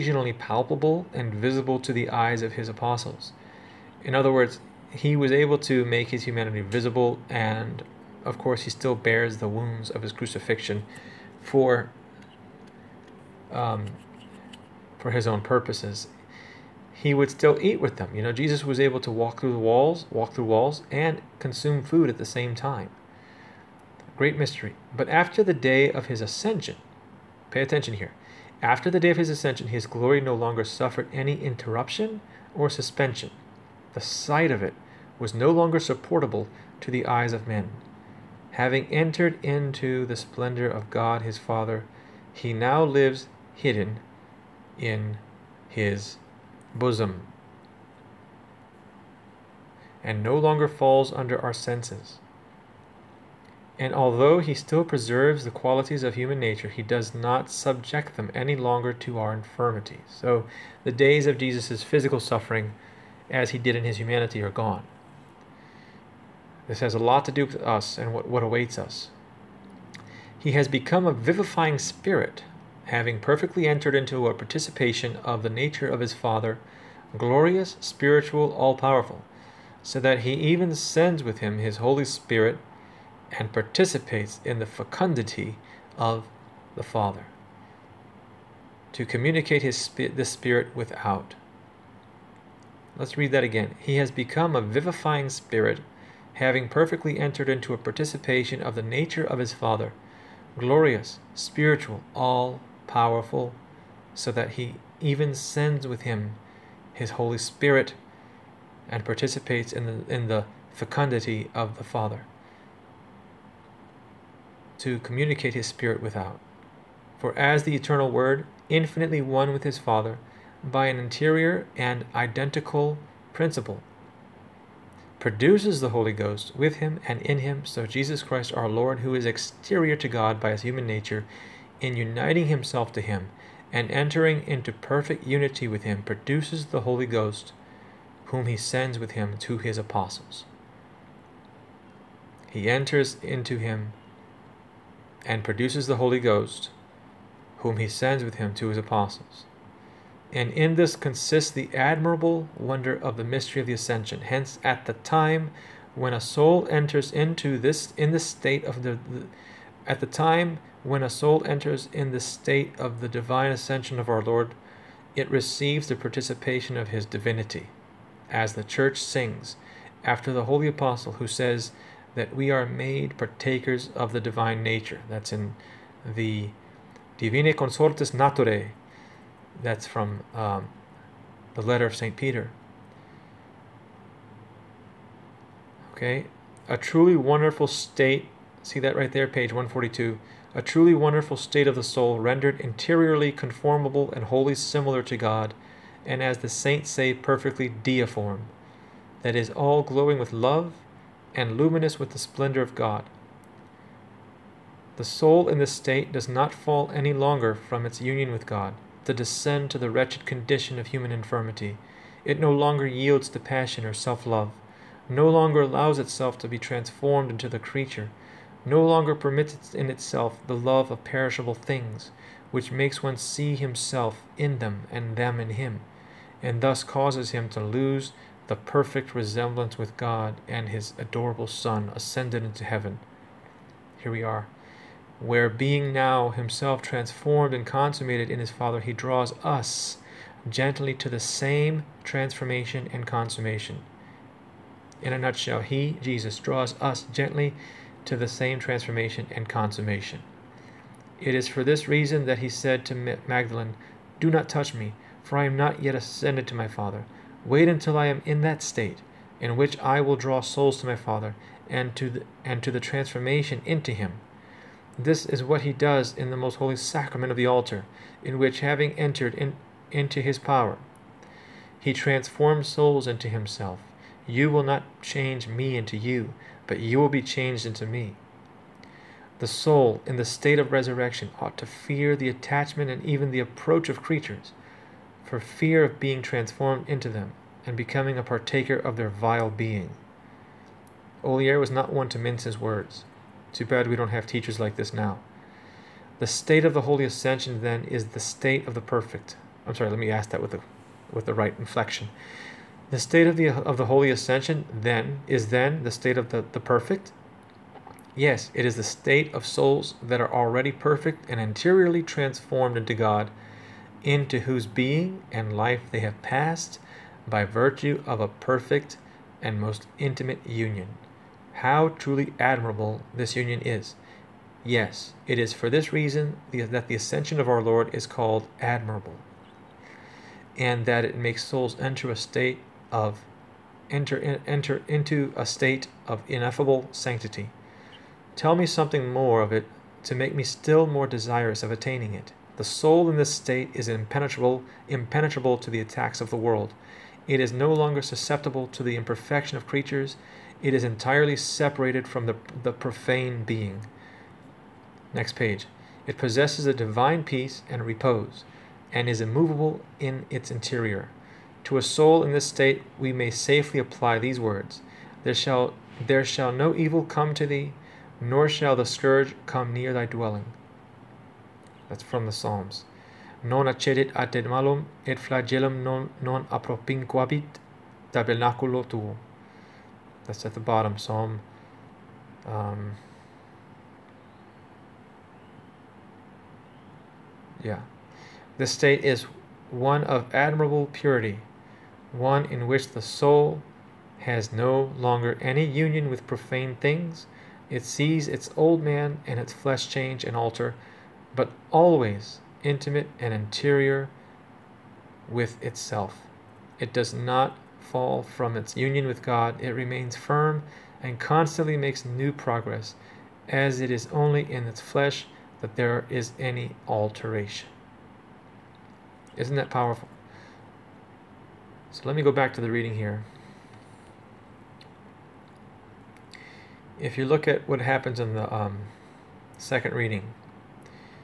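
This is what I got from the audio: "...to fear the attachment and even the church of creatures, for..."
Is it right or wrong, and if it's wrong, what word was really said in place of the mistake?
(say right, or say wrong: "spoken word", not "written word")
wrong: "approach", not "church".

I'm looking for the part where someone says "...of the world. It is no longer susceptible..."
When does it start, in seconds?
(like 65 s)
346 s.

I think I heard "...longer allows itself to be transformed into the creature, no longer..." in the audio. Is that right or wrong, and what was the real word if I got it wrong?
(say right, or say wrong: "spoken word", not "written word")
right.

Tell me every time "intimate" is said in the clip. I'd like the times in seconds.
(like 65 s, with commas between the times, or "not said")
319 s, 402 s.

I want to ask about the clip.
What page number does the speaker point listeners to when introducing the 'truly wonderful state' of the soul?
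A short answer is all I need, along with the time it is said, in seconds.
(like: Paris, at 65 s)
142, at 189 s.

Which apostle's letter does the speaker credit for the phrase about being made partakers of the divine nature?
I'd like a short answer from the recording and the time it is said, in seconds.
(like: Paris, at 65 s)
St. Peter, at 181 s.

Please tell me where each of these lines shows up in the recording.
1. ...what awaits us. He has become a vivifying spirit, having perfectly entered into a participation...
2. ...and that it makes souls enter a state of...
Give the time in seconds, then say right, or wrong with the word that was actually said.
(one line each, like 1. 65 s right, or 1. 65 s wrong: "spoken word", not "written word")
1. 68 s right
2. 330 s right.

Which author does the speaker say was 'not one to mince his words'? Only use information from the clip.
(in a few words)
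Olier.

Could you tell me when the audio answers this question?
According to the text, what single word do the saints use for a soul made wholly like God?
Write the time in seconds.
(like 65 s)
197 s.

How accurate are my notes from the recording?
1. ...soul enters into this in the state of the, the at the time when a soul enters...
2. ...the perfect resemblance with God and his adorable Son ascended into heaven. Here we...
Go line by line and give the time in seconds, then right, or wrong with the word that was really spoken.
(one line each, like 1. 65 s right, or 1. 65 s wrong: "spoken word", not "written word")
1. 156 s right
2. 228 s right.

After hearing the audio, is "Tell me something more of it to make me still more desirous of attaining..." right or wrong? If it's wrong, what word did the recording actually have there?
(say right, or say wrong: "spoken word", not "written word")
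right.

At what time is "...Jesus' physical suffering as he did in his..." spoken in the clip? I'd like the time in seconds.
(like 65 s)
61 s.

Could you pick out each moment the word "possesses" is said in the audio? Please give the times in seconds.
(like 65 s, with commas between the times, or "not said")
356 s.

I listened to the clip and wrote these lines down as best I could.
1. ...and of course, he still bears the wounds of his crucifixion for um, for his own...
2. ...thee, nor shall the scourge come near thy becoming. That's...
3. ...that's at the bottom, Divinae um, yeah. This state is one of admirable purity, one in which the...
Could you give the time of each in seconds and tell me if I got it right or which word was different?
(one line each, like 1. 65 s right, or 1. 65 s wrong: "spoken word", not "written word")
1. 7 s right
2. 367 s wrong: "dwelling", not "becoming"
3. 380 s wrong: "Psalm", not "Divinae".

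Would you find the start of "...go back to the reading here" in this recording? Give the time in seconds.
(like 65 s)
422 s.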